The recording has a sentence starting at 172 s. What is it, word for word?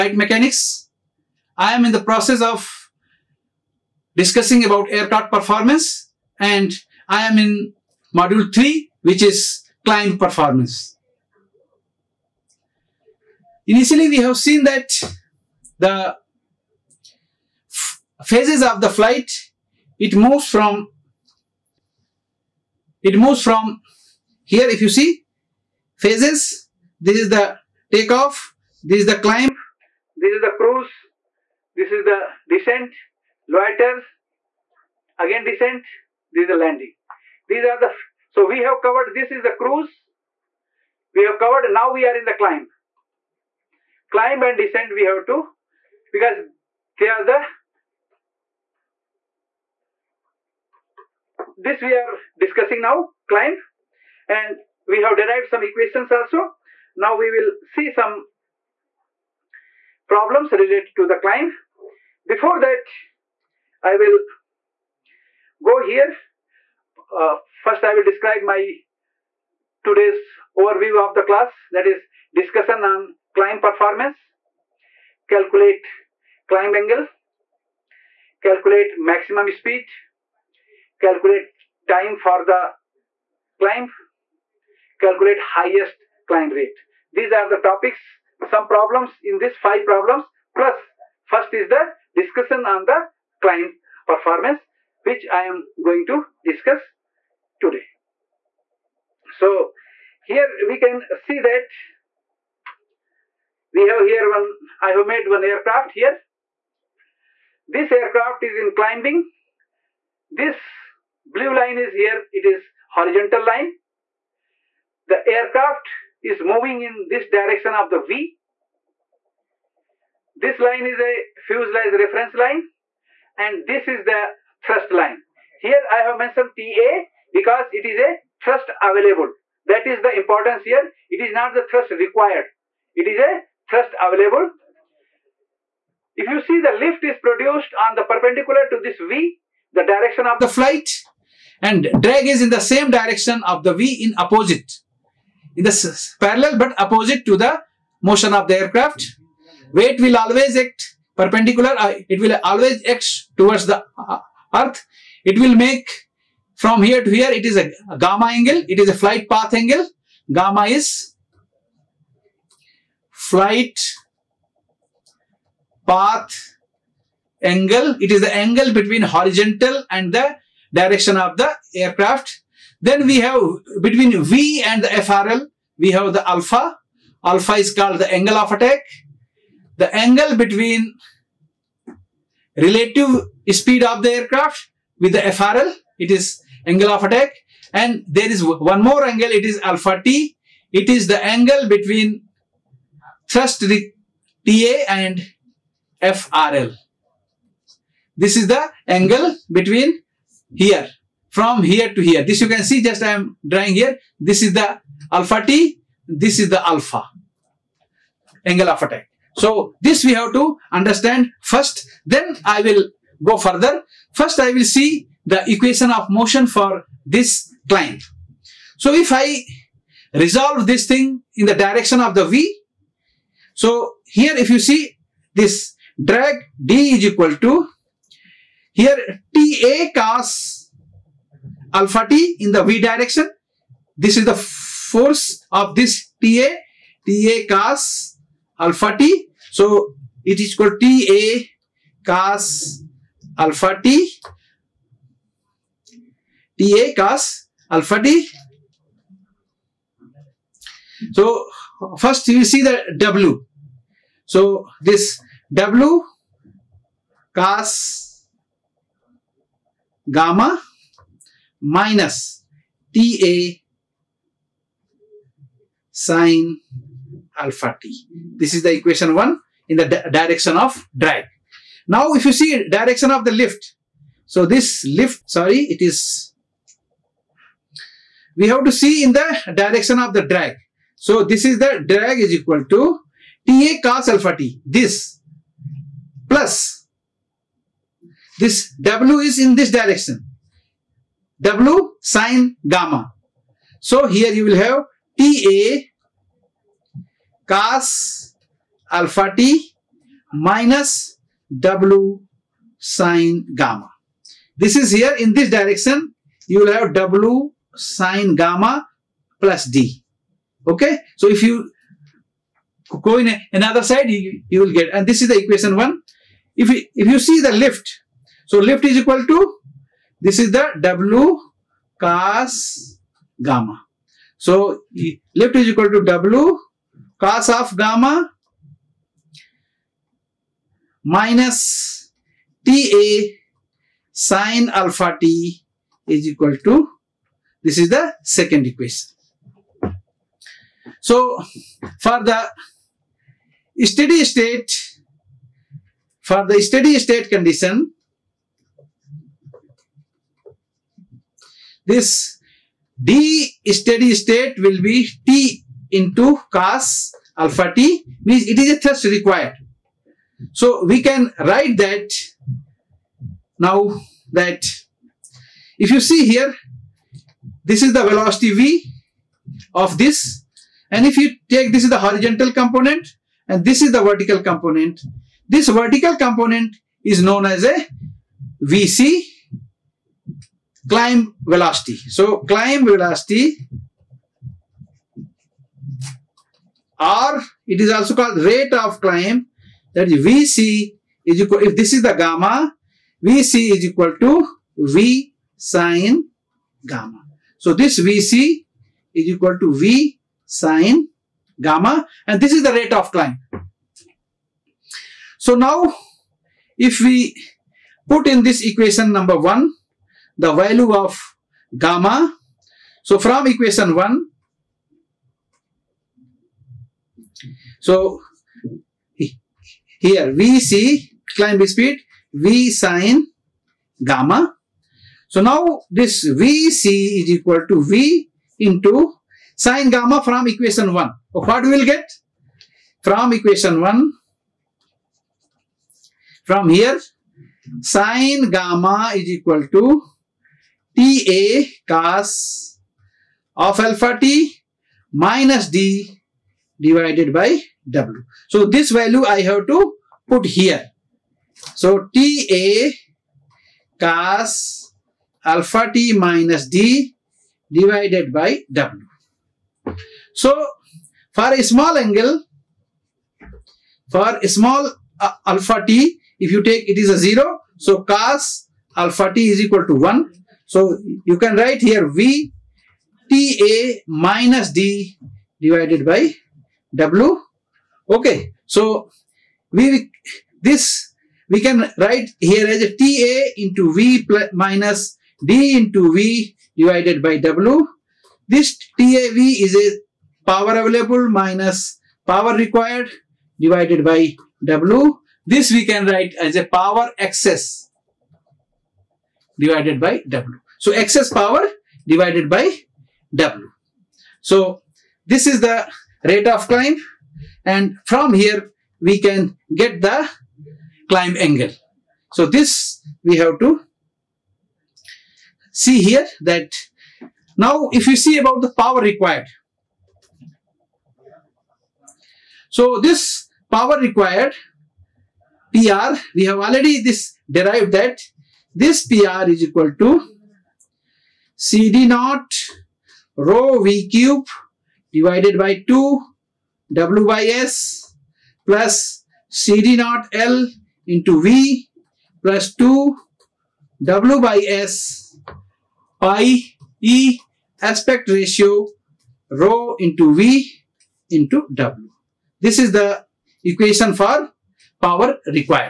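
Then we have between V and the FRL, we have the alpha.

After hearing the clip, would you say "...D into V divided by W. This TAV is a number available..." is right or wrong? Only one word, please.
wrong.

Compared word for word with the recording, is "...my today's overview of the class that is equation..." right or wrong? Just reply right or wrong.
wrong.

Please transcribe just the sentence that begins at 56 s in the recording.
Now we will see some problems related to the climb.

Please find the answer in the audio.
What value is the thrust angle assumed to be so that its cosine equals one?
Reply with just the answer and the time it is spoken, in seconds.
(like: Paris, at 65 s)
0, at 467 s.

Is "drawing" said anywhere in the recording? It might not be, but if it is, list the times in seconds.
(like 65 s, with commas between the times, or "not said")
203 s.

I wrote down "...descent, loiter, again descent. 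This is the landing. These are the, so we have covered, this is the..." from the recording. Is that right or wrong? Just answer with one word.
right.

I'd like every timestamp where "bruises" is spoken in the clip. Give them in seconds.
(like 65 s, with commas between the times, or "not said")
not said.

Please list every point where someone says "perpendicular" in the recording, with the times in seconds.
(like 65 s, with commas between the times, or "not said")
138 s, 151 s.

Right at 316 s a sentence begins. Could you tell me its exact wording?
If you, if you see the lift, so lift is equal to, this is the W cos gamma.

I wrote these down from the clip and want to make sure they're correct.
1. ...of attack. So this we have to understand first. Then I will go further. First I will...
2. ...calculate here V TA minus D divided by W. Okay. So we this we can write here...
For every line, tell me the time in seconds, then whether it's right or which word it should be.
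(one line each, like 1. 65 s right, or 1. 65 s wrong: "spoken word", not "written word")
1. 208 s right
2. 471 s wrong: "write", not "calculate".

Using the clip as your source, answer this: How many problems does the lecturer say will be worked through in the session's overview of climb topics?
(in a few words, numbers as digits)
five.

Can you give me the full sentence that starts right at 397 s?
So this Vc is equal to V sine gamma and this is the rate of climb.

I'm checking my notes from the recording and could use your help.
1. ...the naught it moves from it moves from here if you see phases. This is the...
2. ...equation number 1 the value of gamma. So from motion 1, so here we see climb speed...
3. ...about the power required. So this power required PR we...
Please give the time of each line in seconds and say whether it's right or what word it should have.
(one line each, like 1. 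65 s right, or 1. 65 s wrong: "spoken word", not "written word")
1. 18 s wrong: "flight", not "naught"
2. 408 s wrong: "equation", not "motion"
3. 518 s right.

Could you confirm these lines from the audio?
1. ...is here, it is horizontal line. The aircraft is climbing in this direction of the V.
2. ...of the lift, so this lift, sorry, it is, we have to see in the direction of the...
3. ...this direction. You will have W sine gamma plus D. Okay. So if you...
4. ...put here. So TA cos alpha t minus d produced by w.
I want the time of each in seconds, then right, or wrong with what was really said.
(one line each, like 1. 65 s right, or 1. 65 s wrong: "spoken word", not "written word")
1. 111 s wrong: "moving", not "climbing"
2. 273 s right
3. 305 s right
4. 450 s wrong: "divided", not "produced".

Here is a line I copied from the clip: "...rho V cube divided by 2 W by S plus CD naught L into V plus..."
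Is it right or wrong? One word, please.
right.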